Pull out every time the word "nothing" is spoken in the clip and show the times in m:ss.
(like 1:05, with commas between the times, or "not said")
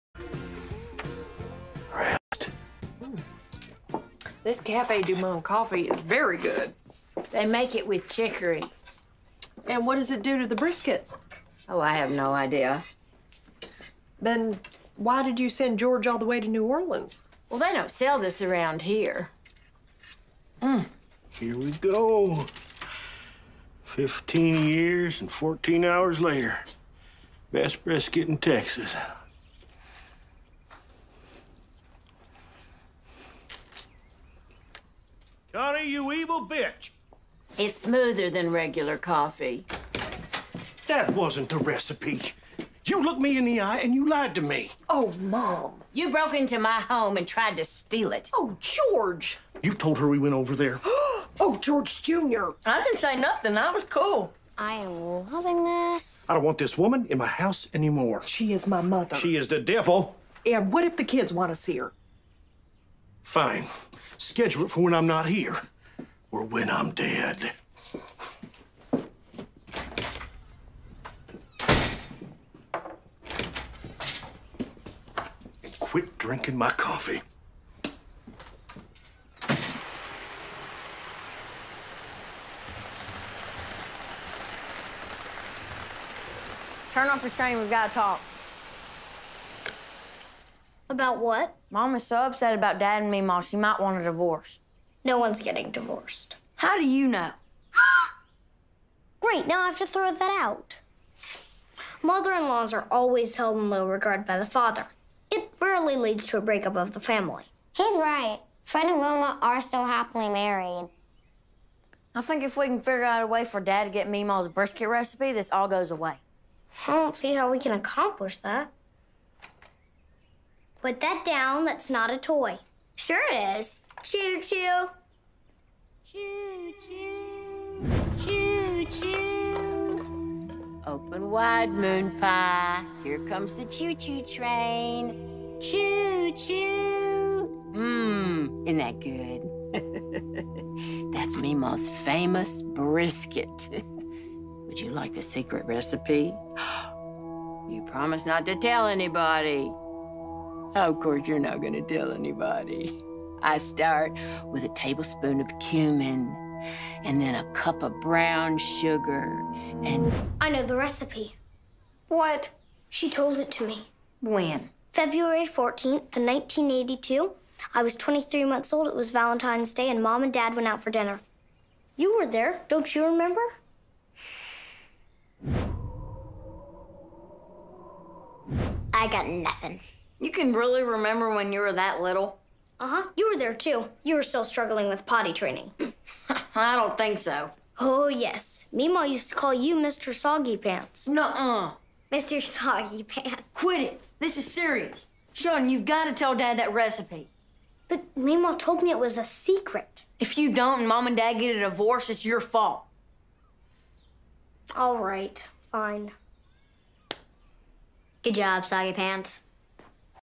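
0:53, 2:59.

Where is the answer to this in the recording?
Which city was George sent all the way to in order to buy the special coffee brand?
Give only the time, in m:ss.
0:16.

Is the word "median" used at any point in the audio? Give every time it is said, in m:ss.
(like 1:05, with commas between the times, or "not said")
not said.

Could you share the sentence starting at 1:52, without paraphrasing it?
I think if we can figure out a way for Dad to get Meemaw's brisket recipe, this all goes away.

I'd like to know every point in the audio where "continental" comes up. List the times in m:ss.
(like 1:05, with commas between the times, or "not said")
not said.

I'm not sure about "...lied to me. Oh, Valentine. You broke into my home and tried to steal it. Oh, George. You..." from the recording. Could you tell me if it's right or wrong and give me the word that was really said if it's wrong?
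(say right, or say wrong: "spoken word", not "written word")
wrong: "Mom", not "Valentine".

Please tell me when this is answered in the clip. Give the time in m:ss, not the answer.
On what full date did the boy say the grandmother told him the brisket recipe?
2:44.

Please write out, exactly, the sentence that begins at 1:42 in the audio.
Mother-in-laws are always held in low regard by the father.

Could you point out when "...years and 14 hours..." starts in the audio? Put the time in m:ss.
0:24.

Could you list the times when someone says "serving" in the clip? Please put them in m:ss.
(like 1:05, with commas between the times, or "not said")
not said.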